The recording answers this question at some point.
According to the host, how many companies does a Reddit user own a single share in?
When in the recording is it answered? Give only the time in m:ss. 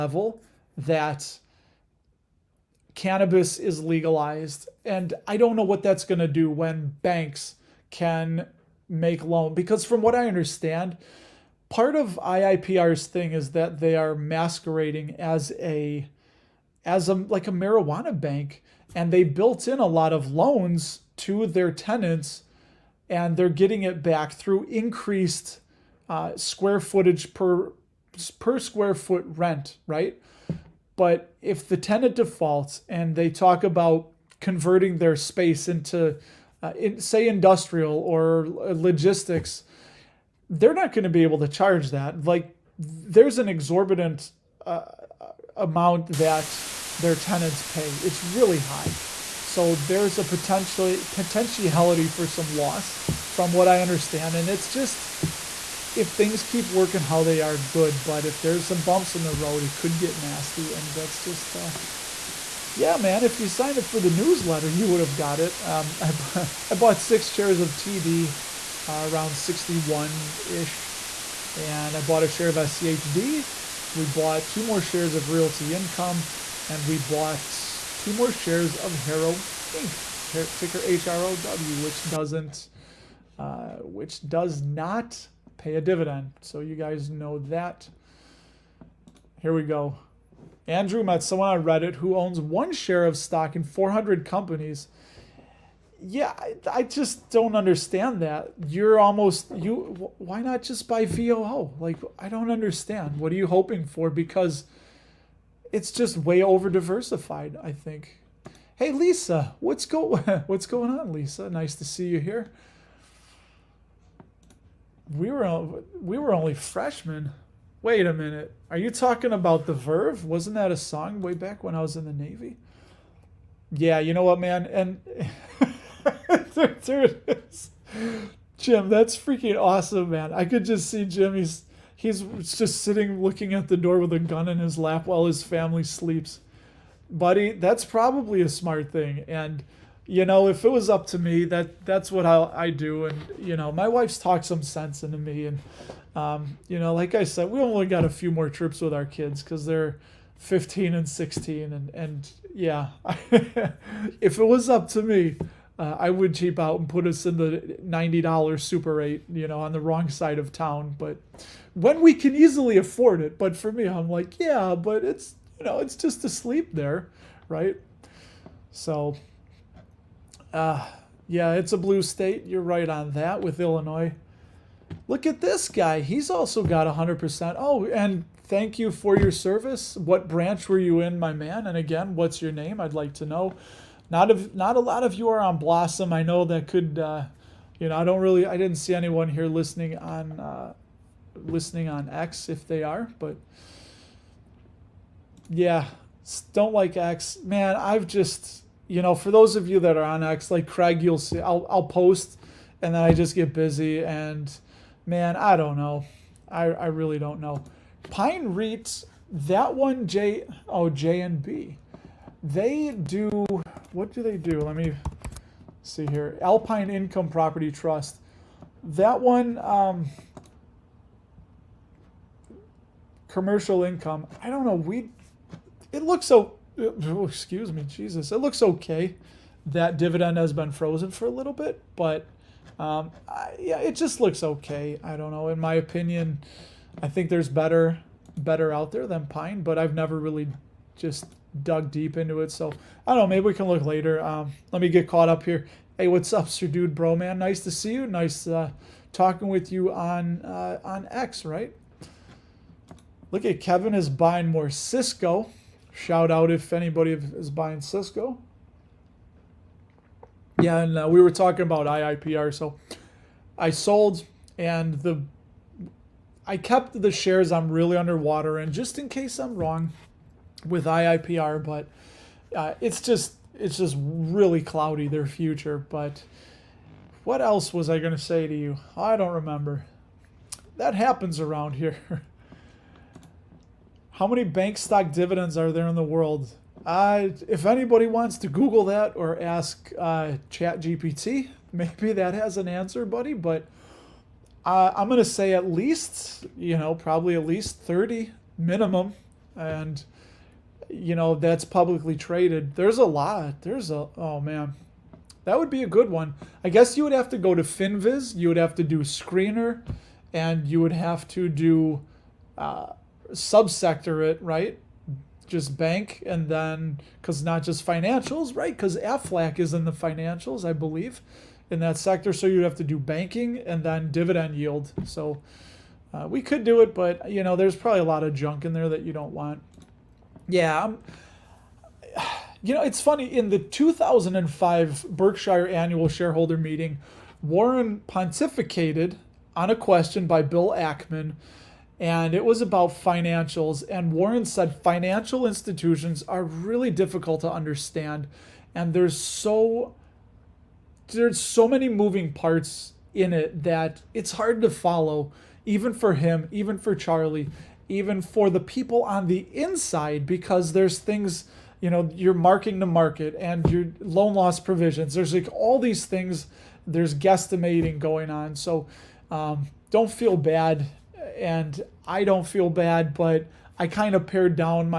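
1:33.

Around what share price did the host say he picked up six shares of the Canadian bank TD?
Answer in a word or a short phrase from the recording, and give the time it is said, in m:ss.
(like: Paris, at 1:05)
61, at 1:09.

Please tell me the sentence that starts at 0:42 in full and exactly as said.
Like, there's an exorbitant uh, uh, amount that their tenants pay.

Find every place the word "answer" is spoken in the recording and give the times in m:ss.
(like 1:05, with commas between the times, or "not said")
4:52.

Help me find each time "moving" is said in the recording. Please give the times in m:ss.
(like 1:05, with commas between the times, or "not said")
5:51.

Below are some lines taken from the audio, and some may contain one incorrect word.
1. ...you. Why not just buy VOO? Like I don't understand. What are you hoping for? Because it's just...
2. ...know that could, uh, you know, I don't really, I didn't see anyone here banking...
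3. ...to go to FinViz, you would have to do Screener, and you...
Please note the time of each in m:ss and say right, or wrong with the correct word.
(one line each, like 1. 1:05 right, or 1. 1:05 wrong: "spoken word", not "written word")
1. 1:39 right
2. 3:06 wrong: "listening", not "banking"
3. 5:07 right.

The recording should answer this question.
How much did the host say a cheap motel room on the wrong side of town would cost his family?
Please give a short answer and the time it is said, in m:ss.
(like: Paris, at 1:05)
$90, at 2:37.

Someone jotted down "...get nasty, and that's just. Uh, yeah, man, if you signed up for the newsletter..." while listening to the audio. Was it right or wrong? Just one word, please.
right.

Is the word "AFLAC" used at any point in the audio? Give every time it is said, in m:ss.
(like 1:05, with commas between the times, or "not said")
5:18.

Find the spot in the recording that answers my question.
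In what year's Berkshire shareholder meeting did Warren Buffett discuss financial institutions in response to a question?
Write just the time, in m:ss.
5:33.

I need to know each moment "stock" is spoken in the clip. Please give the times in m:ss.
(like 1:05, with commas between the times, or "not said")
1:33, 4:44.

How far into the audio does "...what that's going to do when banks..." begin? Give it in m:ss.
0:05.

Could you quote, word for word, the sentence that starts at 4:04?
Um, let me get caught up here.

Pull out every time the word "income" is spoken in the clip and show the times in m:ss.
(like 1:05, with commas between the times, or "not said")
1:15, 3:36, 3:43.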